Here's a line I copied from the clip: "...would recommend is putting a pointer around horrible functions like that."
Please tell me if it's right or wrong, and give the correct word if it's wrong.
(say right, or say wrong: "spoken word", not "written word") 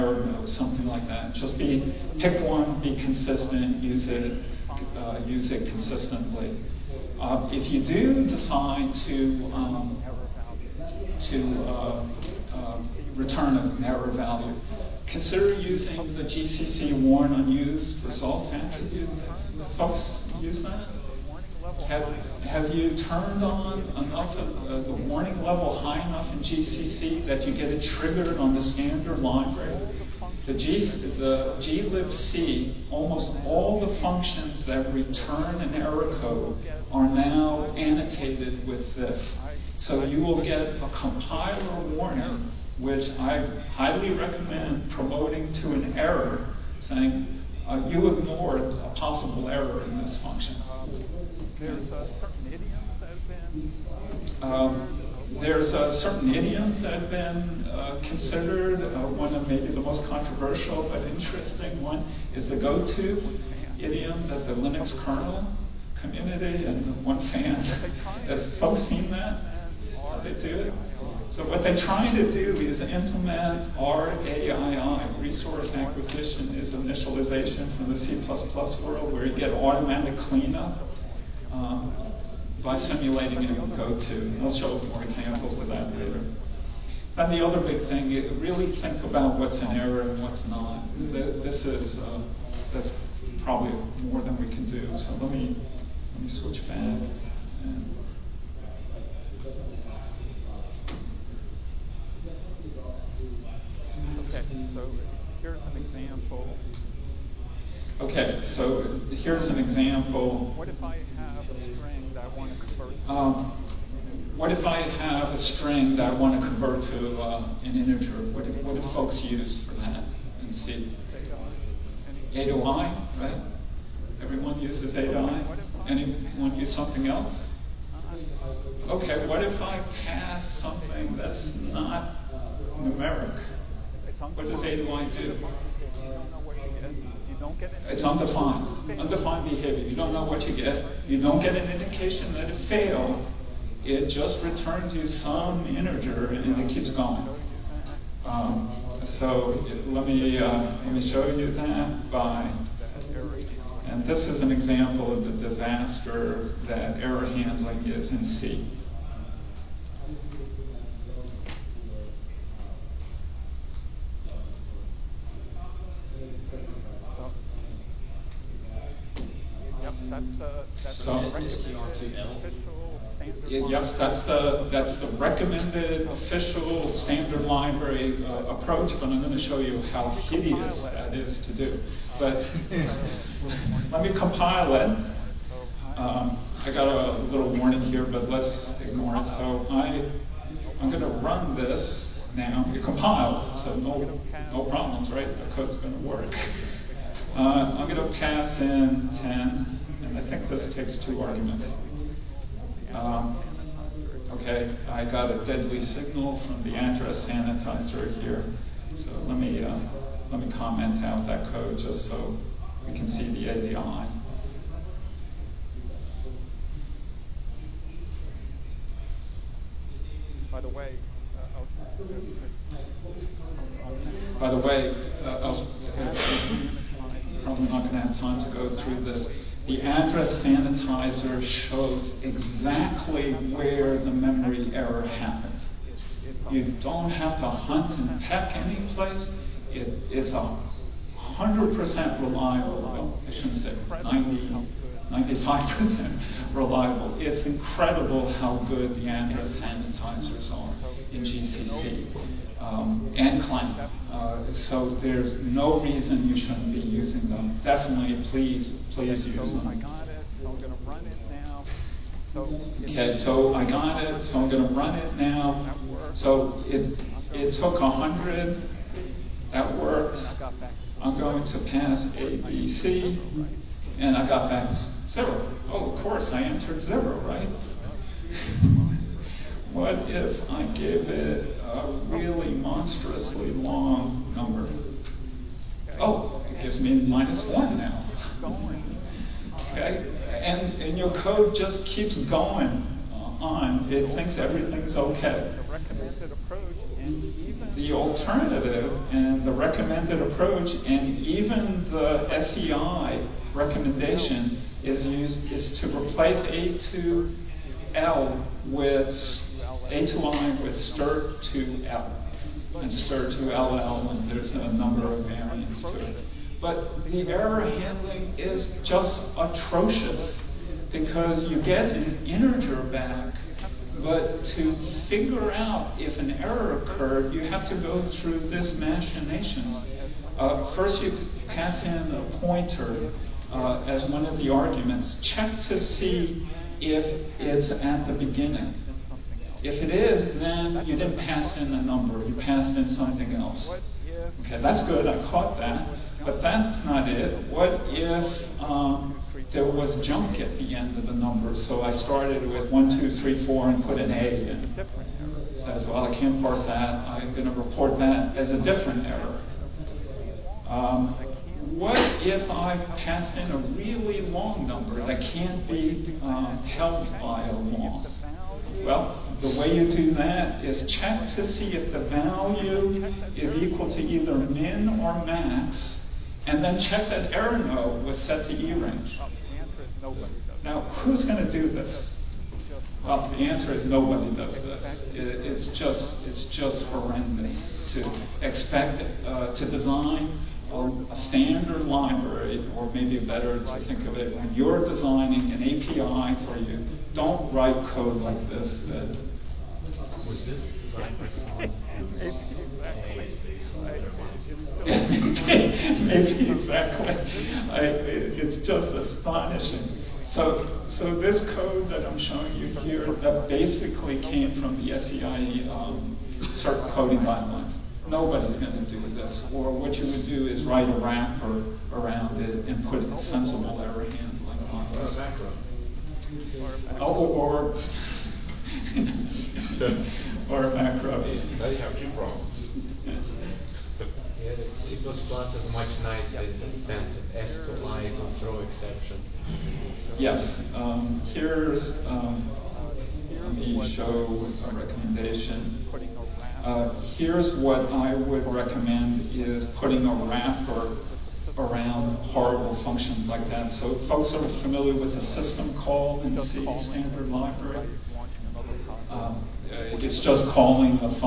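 wrong: "wrapper", not "pointer".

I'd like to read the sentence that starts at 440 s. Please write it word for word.
Yes, um, here's um, let me show a recommendation.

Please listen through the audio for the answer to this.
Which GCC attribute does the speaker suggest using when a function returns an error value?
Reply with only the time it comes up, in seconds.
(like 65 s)
17 s.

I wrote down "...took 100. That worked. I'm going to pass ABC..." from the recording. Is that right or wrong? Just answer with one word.
right.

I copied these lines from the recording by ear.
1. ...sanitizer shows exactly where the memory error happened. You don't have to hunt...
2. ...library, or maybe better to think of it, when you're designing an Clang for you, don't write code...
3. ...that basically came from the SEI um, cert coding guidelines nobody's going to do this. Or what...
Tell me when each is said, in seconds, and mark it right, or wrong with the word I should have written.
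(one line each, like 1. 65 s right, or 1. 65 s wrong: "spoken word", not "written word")
1. 230 s right
2. 391 s wrong: "API", not "Clang"
3. 413 s right.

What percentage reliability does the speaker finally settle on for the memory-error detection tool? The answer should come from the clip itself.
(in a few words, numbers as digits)
95%.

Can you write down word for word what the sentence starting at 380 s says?
Now, who's going to do this?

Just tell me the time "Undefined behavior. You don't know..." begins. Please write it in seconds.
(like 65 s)
138 s.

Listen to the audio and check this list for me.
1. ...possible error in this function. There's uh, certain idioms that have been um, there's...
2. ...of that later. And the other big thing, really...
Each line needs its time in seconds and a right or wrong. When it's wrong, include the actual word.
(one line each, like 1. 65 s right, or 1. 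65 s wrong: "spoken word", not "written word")
1. 48 s right
2. 85 s right.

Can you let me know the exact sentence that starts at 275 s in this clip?
Oh, of course, I entered zero, right?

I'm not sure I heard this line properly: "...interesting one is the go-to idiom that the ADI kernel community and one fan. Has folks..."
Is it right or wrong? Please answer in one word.
wrong.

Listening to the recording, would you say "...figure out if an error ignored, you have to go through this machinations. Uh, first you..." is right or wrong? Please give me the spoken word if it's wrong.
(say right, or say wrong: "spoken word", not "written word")
wrong: "occurred", not "ignored".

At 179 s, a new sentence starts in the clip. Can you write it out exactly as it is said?
But I'm going to show you how hideous that is to do.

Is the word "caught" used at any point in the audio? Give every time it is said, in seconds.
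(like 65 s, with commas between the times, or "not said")
345 s.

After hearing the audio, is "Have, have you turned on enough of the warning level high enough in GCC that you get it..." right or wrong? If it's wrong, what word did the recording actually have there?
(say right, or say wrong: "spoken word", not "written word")
right.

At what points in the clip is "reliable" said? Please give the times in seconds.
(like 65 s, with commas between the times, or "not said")
242 s, 246 s.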